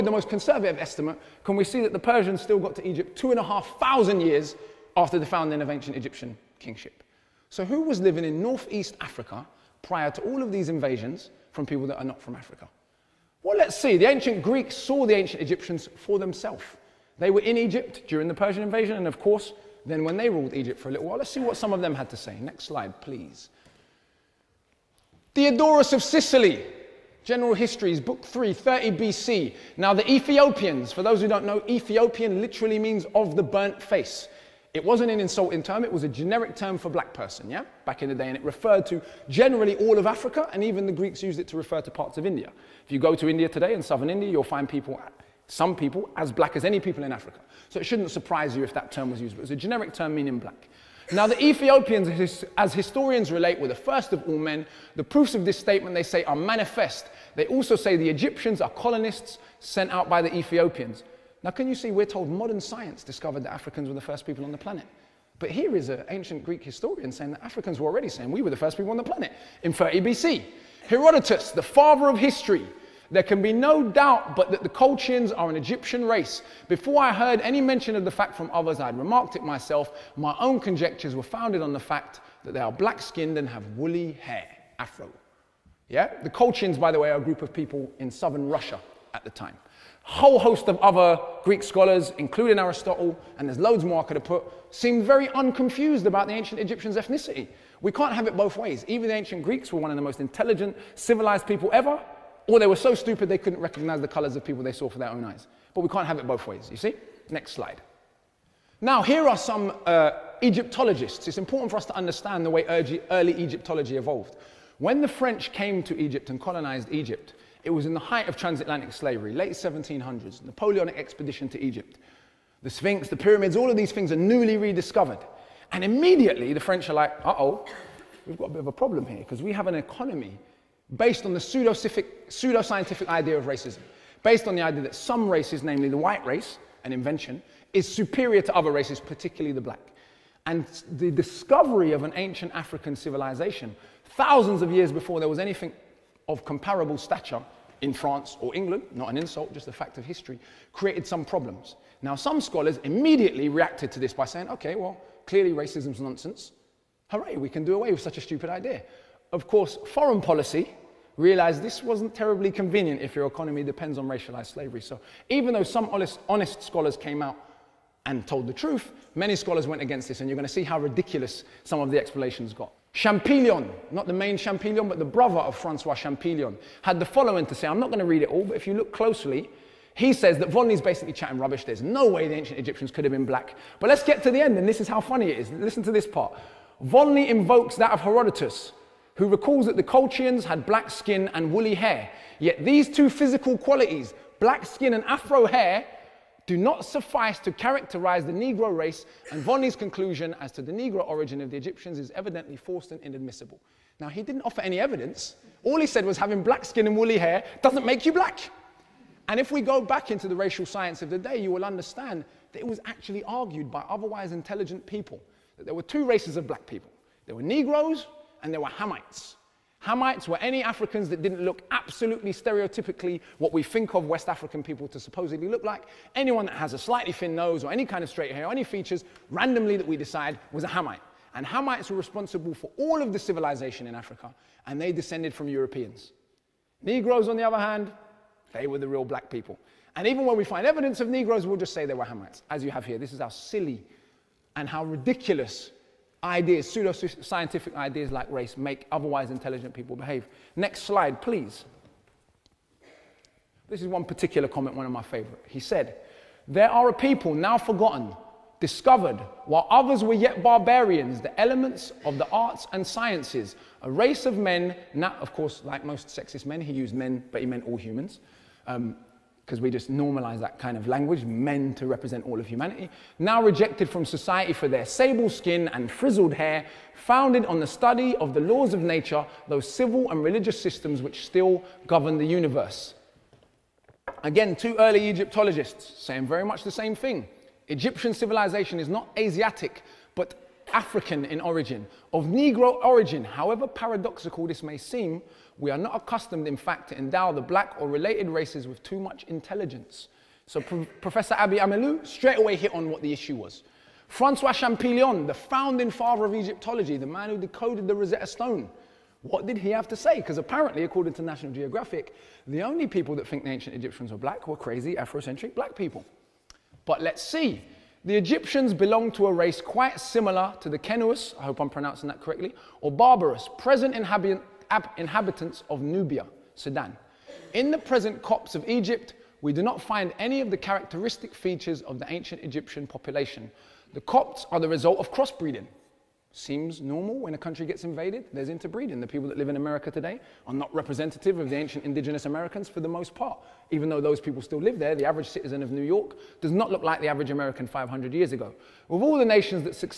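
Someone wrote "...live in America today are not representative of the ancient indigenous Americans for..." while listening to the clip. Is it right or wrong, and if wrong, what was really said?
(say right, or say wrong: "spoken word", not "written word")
right.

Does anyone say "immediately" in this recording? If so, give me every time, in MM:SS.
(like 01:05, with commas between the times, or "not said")
02:05, 02:32.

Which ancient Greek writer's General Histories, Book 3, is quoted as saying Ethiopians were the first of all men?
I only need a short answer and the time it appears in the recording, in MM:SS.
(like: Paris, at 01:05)
Diodorus of Sicily, at 00:25.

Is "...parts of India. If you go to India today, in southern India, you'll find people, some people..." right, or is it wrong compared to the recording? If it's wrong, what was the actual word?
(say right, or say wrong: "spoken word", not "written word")
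right.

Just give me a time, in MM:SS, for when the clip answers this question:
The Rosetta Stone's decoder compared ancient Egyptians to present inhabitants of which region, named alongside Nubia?
05:26.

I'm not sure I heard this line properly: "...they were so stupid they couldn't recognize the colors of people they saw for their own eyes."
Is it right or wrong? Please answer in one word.
right.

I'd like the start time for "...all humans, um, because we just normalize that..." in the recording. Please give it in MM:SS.
04:27.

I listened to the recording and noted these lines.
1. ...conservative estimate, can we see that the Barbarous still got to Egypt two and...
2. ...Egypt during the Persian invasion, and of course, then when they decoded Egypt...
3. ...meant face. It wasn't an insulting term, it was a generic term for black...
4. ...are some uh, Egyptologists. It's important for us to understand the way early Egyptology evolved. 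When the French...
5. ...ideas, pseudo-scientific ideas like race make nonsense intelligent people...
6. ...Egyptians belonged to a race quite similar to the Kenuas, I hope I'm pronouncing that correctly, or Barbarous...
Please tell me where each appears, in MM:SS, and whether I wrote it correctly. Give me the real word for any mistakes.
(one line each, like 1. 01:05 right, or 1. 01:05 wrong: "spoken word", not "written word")
1. 00:00 wrong: "Persians", not "Barbarous"
2. 00:17 wrong: "ruled", not "decoded"
3. 00:33 wrong: "burnt", not "meant"
4. 01:49 right
5. 04:06 wrong: "otherwise", not "nonsense"
6. 05:18 right.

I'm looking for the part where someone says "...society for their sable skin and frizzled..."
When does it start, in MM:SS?
04:34.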